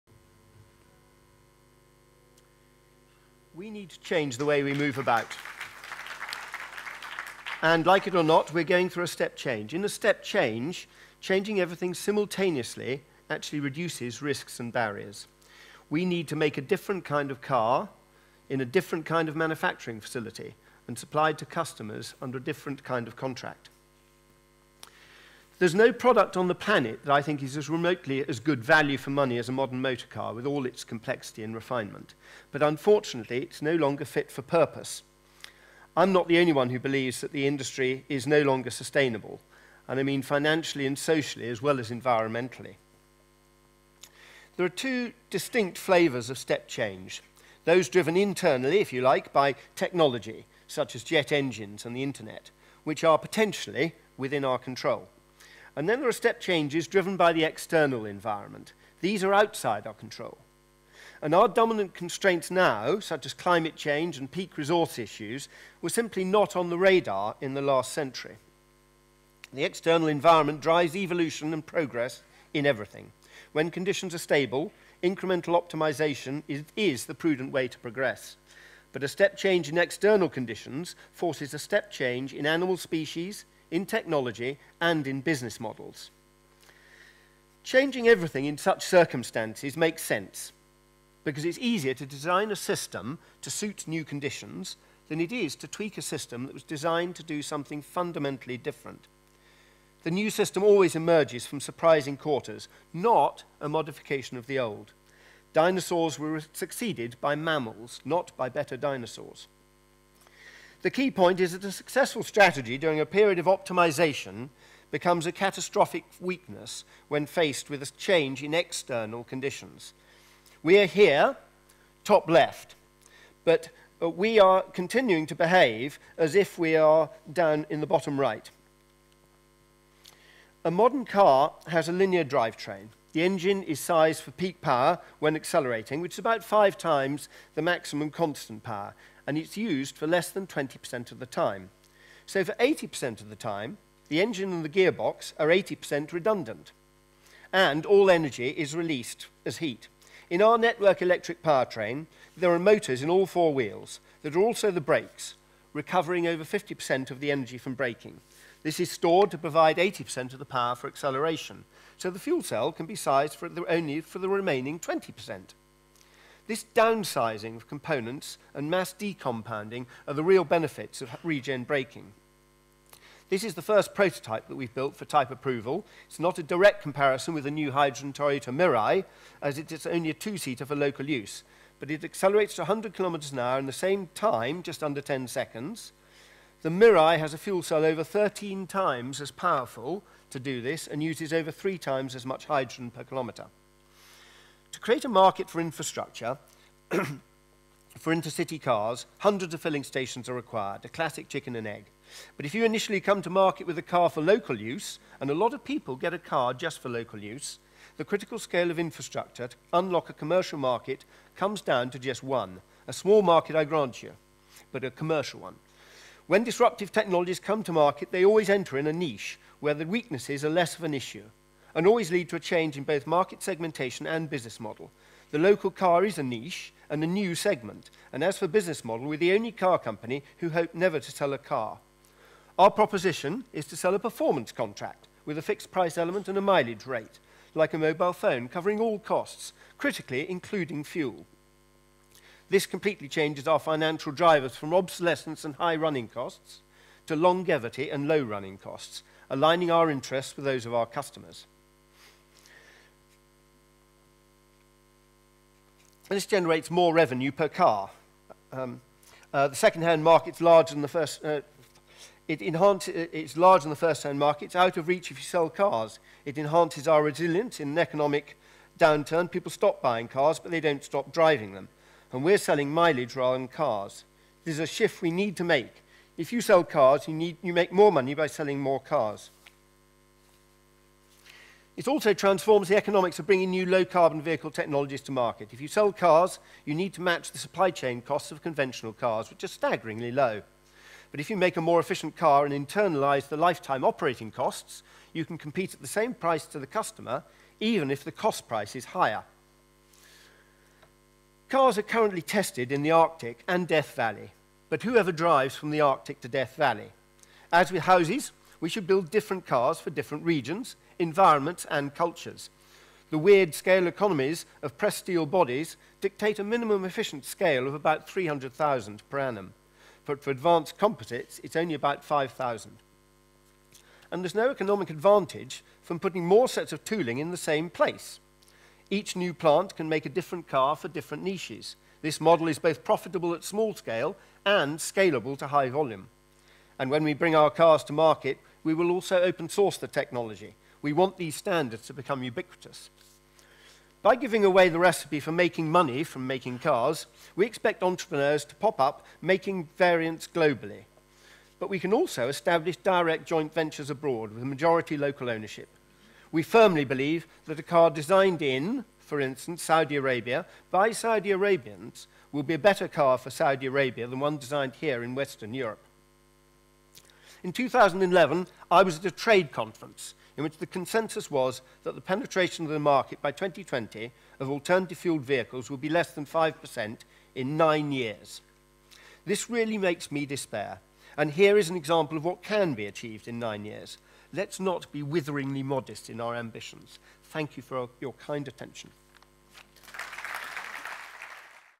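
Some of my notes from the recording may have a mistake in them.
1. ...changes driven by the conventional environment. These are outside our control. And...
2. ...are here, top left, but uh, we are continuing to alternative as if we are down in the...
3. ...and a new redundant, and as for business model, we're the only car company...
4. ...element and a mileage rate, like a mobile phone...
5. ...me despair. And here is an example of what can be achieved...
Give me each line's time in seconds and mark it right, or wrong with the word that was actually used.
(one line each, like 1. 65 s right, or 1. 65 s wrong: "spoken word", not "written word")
1. 56 s wrong: "external", not "conventional"
2. 120 s wrong: "behave", not "alternative"
3. 226 s wrong: "segment", not "redundant"
4. 235 s right
5. 380 s right.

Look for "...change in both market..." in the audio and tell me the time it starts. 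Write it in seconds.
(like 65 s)
222 s.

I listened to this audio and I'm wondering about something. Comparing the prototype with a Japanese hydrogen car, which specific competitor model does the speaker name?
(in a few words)
Toyota Mirai.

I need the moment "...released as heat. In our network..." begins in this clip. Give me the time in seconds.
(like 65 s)
148 s.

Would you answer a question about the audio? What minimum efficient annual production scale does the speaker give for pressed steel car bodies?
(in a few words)
300,000.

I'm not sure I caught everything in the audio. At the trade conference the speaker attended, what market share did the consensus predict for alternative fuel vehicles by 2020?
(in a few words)
less than 5%.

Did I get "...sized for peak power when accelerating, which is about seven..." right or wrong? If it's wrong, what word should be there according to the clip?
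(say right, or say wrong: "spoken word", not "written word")
wrong: "five", not "seven".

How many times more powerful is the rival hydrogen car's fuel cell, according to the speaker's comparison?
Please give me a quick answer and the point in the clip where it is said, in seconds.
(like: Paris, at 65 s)
13, at 188 s.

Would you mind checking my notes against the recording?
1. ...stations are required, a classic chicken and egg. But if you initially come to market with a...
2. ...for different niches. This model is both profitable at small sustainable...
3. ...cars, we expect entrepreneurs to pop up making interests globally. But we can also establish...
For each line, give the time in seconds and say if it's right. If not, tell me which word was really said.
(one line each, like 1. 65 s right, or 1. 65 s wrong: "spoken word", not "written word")
1. 199 s right
2. 330 s wrong: "scale", not "sustainable"
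3. 346 s wrong: "variants", not "interests".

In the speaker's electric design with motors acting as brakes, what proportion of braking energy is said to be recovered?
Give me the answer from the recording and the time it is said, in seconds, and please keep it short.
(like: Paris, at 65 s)
over 50%, at 156 s.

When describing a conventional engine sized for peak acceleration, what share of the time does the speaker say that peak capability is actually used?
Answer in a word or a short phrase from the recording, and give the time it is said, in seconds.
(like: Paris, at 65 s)
less than 20%, at 140 s.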